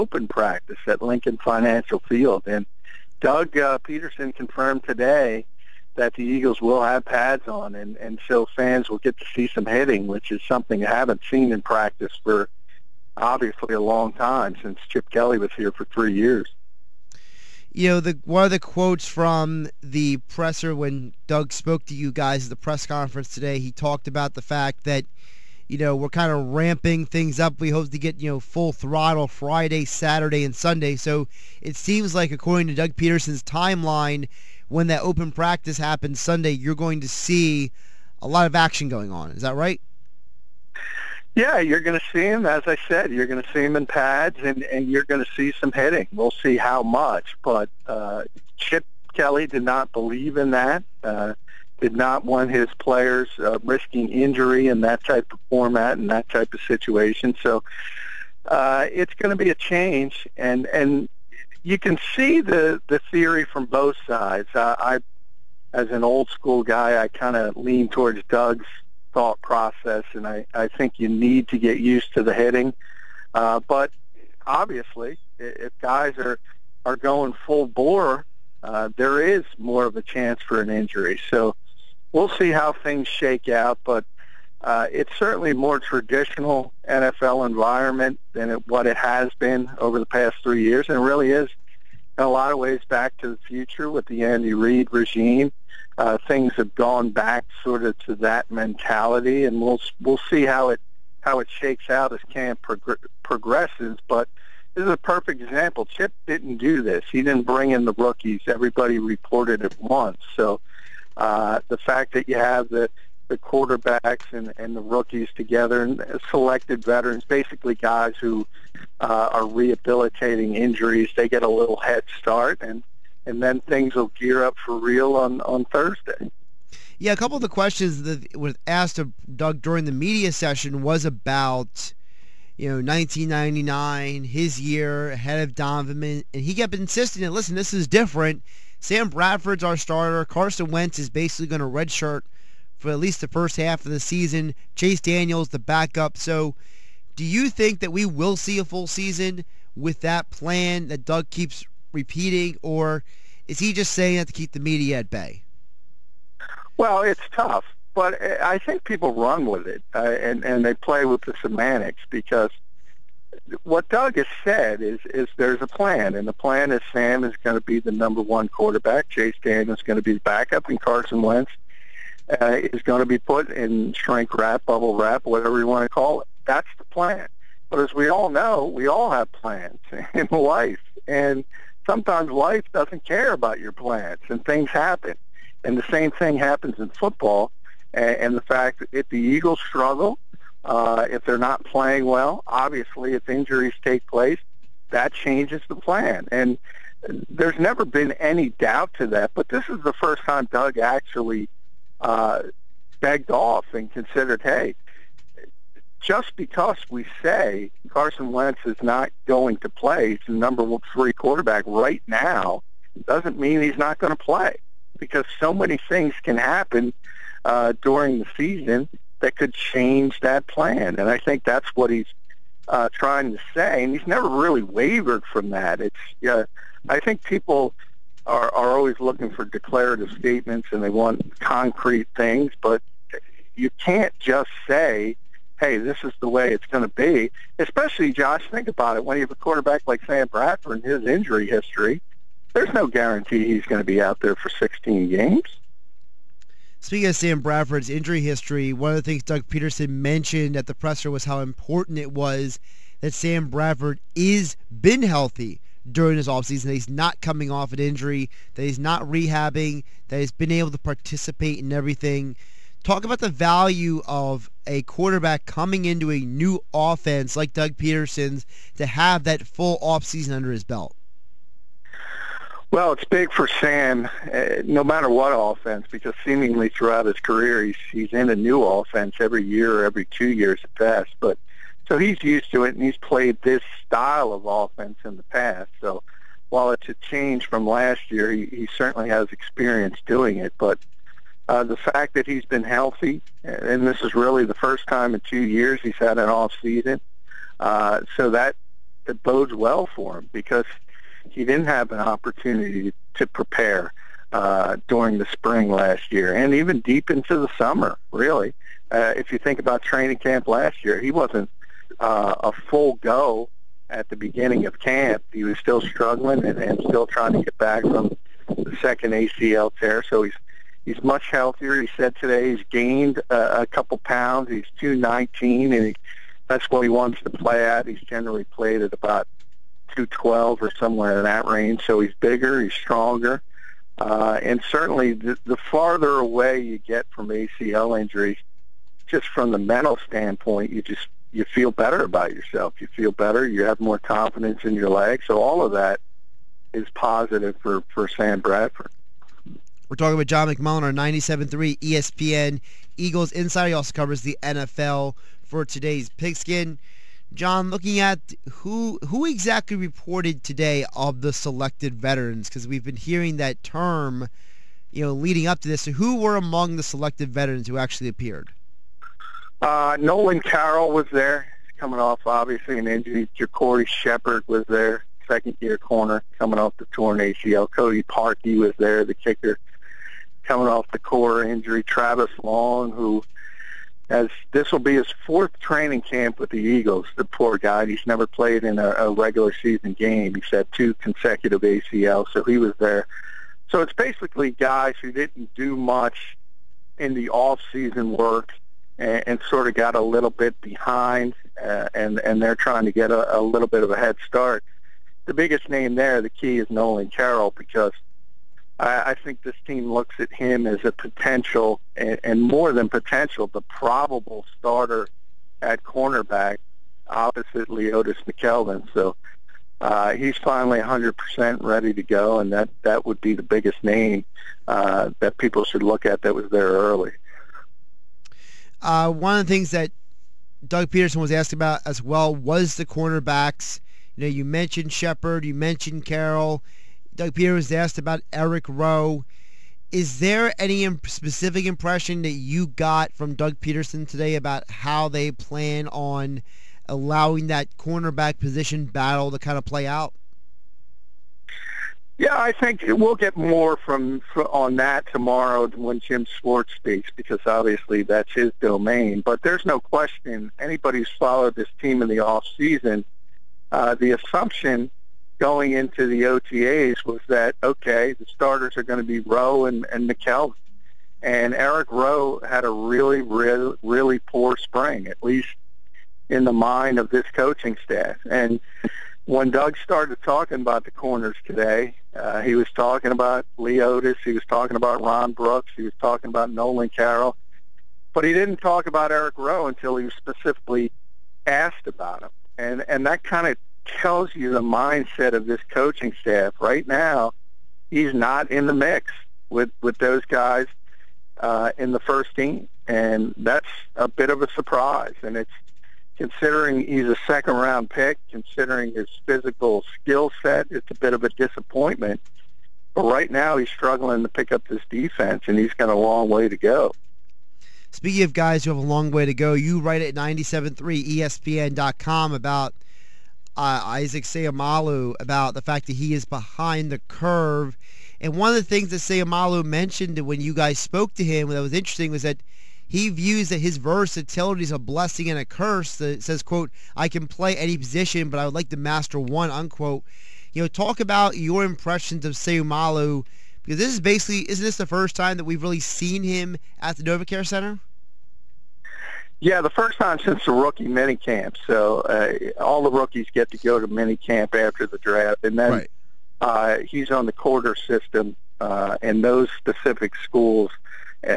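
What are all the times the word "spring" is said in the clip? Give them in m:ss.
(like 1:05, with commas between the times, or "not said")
5:05, 7:54.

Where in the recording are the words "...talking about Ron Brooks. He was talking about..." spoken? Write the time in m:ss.
8:04.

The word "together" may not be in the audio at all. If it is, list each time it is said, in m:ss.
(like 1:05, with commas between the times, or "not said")
1:55.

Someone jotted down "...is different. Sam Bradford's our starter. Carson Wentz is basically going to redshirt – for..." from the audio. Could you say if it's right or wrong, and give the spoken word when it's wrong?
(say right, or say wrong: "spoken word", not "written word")
right.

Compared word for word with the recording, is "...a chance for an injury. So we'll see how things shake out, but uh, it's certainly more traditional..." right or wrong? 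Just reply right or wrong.
right.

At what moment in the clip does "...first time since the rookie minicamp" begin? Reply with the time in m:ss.
9:09.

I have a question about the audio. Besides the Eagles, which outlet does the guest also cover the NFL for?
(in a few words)
Today's Pigskin.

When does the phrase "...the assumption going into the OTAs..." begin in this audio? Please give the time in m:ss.
7:43.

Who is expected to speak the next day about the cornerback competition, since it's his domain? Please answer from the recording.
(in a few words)
Jim Schwartz.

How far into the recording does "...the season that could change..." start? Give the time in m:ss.
3:38.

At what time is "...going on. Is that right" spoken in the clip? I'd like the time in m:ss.
0:38.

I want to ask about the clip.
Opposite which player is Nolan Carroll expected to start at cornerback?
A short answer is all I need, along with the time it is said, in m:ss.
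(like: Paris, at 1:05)
Leodis McKelvin, at 6:57.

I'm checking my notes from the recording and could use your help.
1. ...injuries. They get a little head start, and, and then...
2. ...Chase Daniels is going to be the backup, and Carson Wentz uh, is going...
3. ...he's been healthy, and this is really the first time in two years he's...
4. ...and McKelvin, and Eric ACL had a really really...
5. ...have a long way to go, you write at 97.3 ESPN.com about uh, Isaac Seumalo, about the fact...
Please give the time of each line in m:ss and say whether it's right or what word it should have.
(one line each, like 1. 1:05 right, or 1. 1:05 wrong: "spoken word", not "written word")
1. 2:00 right
2. 2:49 right
3. 4:52 right
4. 7:49 wrong: "Rowe", not "ACL"
5. 8:38 right.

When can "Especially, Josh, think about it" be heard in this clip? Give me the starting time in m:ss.
3:57.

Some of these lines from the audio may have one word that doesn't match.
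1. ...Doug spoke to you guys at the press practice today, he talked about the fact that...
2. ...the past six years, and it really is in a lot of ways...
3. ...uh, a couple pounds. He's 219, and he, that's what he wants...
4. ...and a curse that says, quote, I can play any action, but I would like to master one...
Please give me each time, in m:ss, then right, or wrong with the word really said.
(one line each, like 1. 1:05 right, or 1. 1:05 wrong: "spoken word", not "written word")
1. 0:21 wrong: "conference", not "practice"
2. 1:29 wrong: "three", not "six"
3. 5:23 right
4. 8:55 wrong: "position", not "action".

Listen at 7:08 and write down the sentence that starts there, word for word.
Uh, one of the things that Doug Pederson was asked about as well was the cornerbacks.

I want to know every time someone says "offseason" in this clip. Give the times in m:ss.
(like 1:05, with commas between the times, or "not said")
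4:16, 4:29.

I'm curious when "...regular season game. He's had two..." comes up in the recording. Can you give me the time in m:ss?
6:29.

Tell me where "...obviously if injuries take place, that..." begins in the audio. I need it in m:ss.
3:12.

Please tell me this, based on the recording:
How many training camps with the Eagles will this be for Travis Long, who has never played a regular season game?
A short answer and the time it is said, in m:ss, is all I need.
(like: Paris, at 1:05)
4th, at 6:25.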